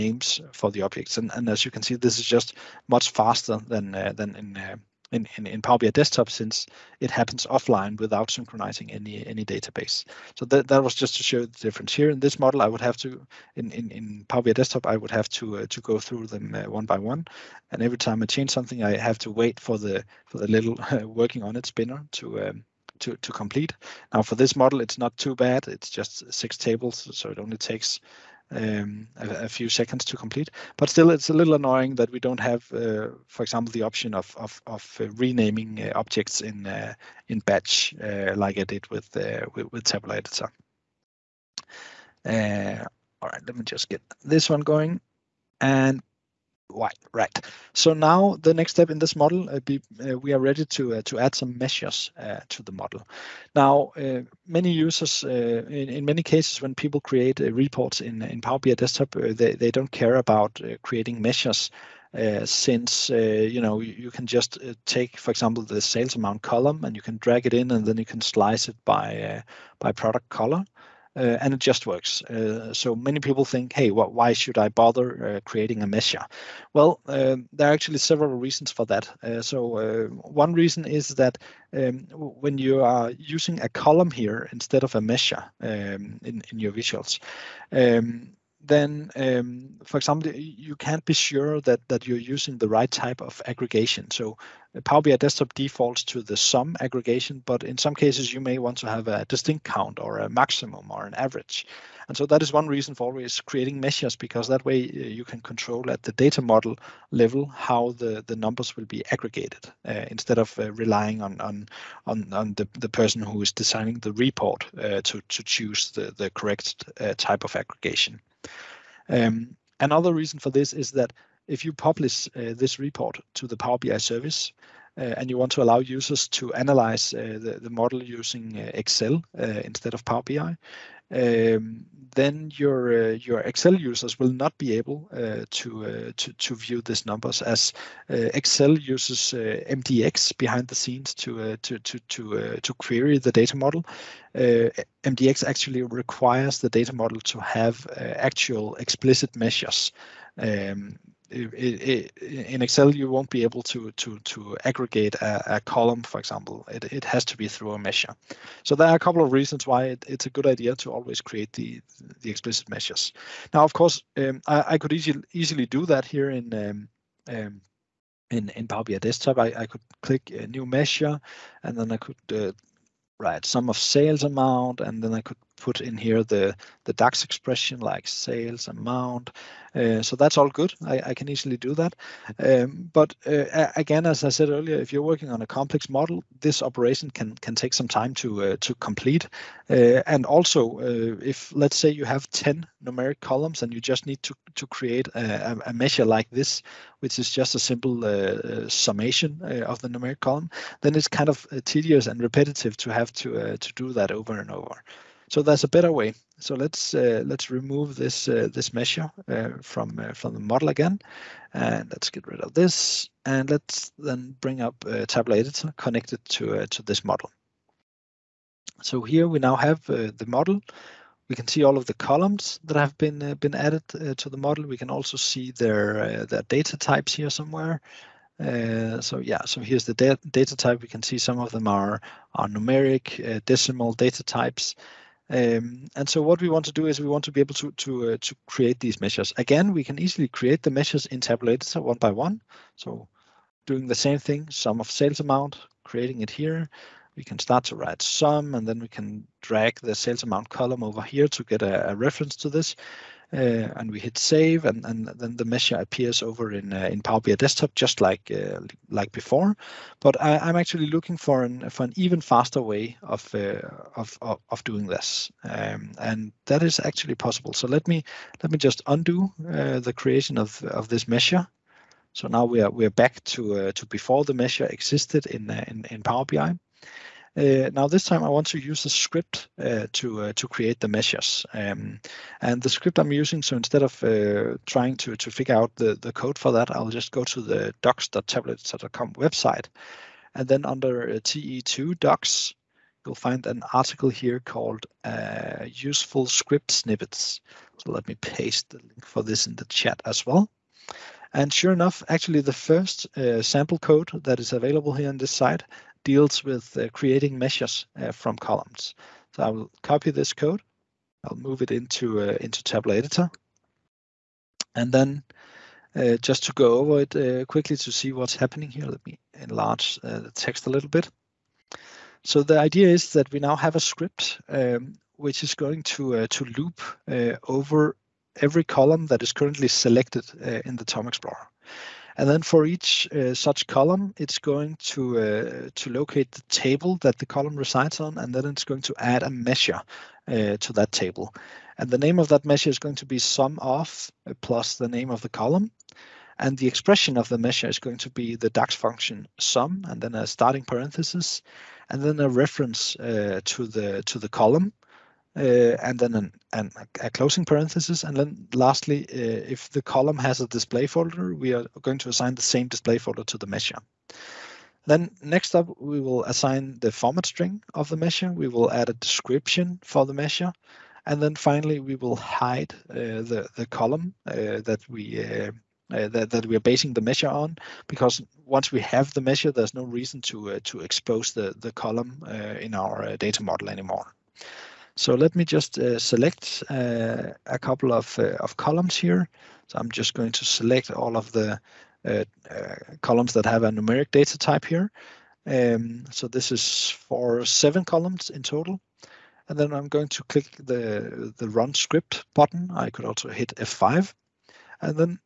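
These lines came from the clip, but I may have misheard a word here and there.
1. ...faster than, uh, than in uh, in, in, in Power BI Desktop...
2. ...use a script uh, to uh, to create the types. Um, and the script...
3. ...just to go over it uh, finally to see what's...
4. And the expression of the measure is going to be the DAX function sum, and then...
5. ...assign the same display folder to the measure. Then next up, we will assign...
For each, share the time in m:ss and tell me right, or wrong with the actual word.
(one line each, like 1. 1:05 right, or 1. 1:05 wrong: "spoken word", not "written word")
1. 0:03 right
2. 4:38 wrong: "measures", not "types"
3. 5:16 wrong: "quickly", not "finally"
4. 5:46 right
5. 6:02 right.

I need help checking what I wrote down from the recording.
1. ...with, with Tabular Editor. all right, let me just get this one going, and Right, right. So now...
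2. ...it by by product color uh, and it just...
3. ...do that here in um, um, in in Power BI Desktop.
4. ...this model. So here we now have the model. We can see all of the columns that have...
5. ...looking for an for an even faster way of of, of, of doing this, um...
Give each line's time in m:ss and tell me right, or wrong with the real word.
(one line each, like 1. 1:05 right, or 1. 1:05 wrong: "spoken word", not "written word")
1. 0:39 right
2. 1:08 right
3. 2:45 right
4. 3:36 right
5. 4:20 right.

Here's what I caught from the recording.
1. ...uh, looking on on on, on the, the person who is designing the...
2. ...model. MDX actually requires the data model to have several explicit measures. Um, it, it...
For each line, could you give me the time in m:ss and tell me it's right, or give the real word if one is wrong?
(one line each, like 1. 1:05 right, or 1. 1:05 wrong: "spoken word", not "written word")
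1. 1:50 wrong: "relying", not "looking"
2. 2:23 wrong: "actual", not "several".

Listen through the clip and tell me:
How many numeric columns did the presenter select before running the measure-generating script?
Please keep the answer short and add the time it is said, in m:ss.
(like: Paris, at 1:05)
7, at 6:37.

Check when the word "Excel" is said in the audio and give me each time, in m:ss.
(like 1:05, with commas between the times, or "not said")
2:08, 2:13, 2:18, 2:32.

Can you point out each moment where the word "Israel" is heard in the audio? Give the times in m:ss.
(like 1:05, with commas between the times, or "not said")
not said.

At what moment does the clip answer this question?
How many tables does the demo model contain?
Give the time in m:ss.
0:26.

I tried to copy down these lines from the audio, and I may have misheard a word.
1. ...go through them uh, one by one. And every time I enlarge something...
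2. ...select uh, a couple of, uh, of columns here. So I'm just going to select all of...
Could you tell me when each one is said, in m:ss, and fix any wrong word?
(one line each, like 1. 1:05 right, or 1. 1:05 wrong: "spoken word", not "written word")
1. 0:15 wrong: "change", not "enlarge"
2. 6:25 right.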